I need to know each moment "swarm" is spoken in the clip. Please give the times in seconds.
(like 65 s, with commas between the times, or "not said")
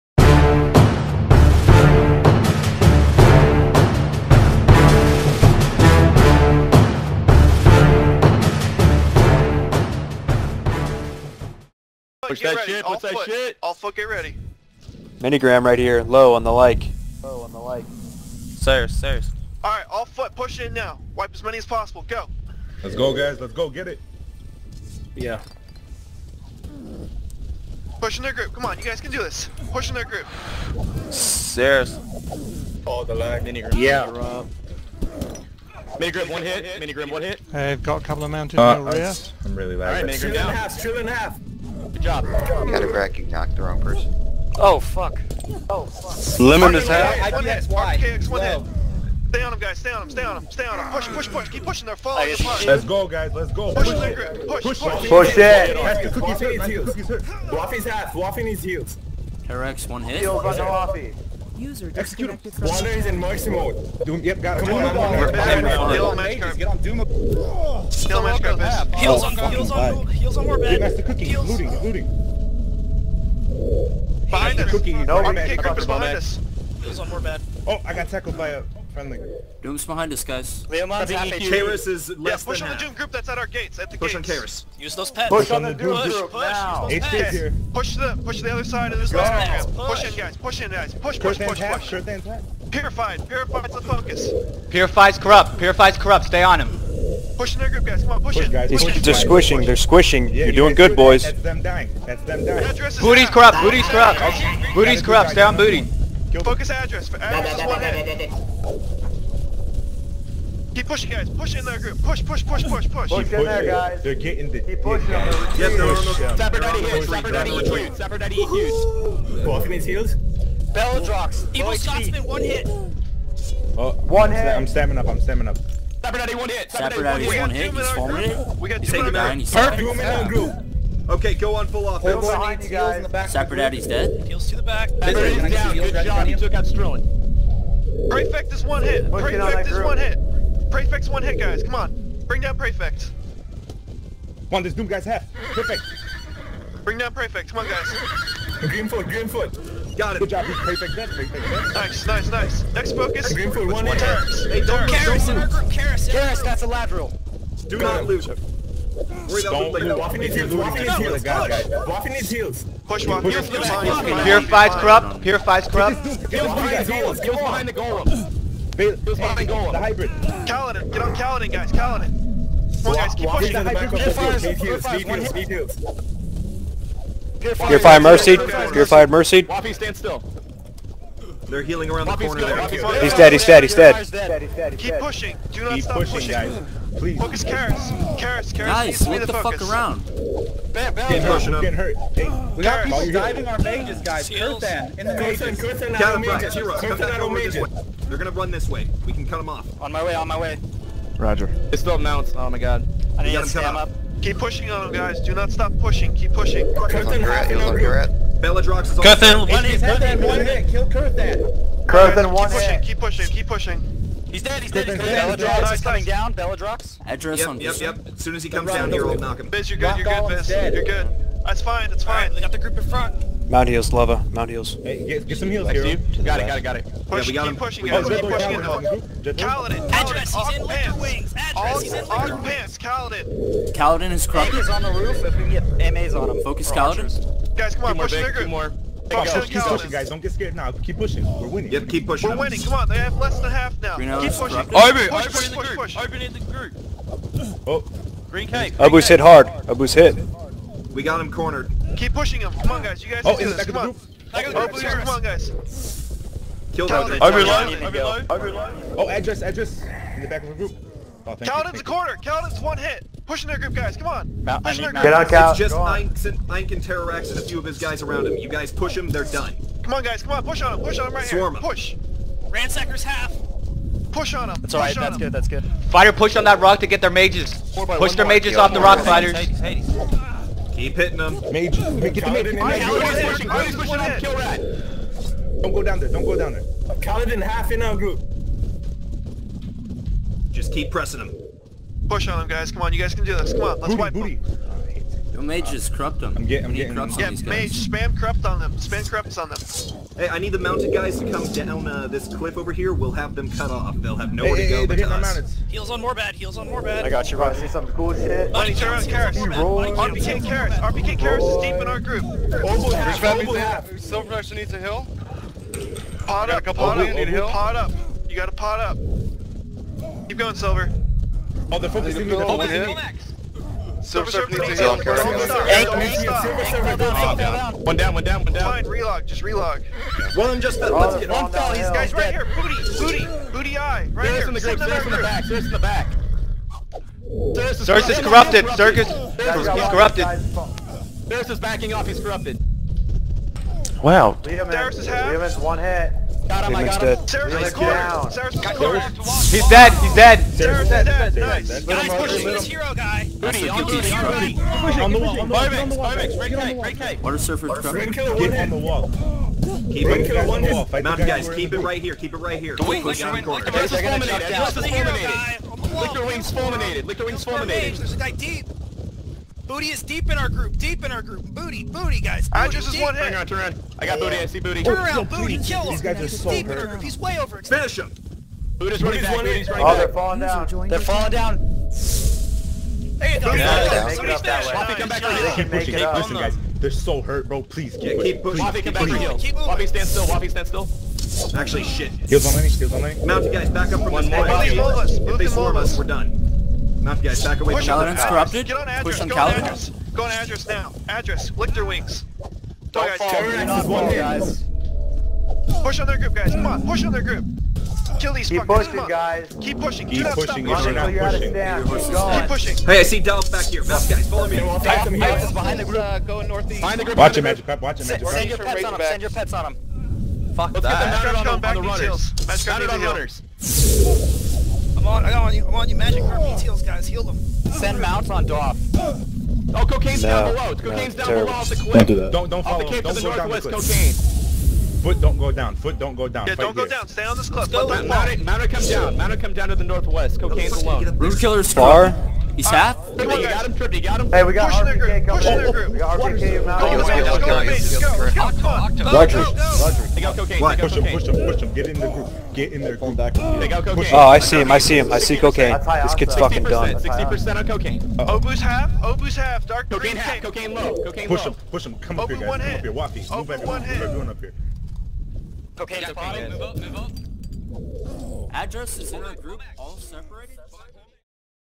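271 s, 395 s.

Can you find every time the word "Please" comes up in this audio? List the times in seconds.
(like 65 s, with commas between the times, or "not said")
186 s, 387 s.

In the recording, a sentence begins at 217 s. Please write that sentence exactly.
Address yep, Yep, yep, As soon as he comes down here, we'll knock him.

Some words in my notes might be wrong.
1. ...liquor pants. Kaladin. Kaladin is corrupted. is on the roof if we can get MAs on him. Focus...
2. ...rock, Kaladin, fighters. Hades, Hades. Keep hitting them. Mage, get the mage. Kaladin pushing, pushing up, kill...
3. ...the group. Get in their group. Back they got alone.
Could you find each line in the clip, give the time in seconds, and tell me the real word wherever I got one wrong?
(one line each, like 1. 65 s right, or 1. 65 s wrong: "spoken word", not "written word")
1. 232 s right
2. 278 s wrong: "Hades", not "Kaladin"
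3. 451 s wrong: "cocaine", not "alone".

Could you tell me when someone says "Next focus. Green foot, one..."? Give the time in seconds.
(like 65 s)
152 s.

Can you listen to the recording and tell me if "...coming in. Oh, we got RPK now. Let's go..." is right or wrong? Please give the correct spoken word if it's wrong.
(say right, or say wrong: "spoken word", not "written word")
right.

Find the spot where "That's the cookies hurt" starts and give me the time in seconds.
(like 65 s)
55 s.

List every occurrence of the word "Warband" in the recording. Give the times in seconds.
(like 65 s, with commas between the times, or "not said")
70 s, 77 s.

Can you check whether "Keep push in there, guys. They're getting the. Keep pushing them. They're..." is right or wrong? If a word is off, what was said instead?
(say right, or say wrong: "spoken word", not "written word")
right.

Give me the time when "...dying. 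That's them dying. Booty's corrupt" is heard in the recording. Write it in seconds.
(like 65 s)
101 s.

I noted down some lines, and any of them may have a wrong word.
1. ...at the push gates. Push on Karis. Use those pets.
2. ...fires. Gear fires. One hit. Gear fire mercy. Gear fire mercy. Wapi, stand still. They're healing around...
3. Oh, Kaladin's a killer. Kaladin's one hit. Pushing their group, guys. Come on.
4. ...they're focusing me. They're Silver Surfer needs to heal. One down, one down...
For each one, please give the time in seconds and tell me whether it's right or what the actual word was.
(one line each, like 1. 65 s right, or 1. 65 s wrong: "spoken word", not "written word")
1. 83 s right
2. 174 s right
3. 261 s wrong: "corner", not "killer"
4. 321 s right.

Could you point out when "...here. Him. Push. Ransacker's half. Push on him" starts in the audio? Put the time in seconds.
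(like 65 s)
271 s.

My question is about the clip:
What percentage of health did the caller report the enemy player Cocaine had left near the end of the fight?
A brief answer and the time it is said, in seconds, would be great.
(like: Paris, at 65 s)
60%, at 456 s.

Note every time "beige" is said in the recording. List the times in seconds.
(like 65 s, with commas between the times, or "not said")
not said.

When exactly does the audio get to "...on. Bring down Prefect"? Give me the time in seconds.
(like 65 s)
141 s.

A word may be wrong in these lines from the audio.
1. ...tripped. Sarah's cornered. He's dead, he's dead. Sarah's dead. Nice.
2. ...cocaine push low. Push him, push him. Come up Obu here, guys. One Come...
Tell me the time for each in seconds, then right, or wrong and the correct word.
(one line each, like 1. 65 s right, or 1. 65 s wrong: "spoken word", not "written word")
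1. 347 s wrong: "cornered", not "tripped"
2. 461 s right.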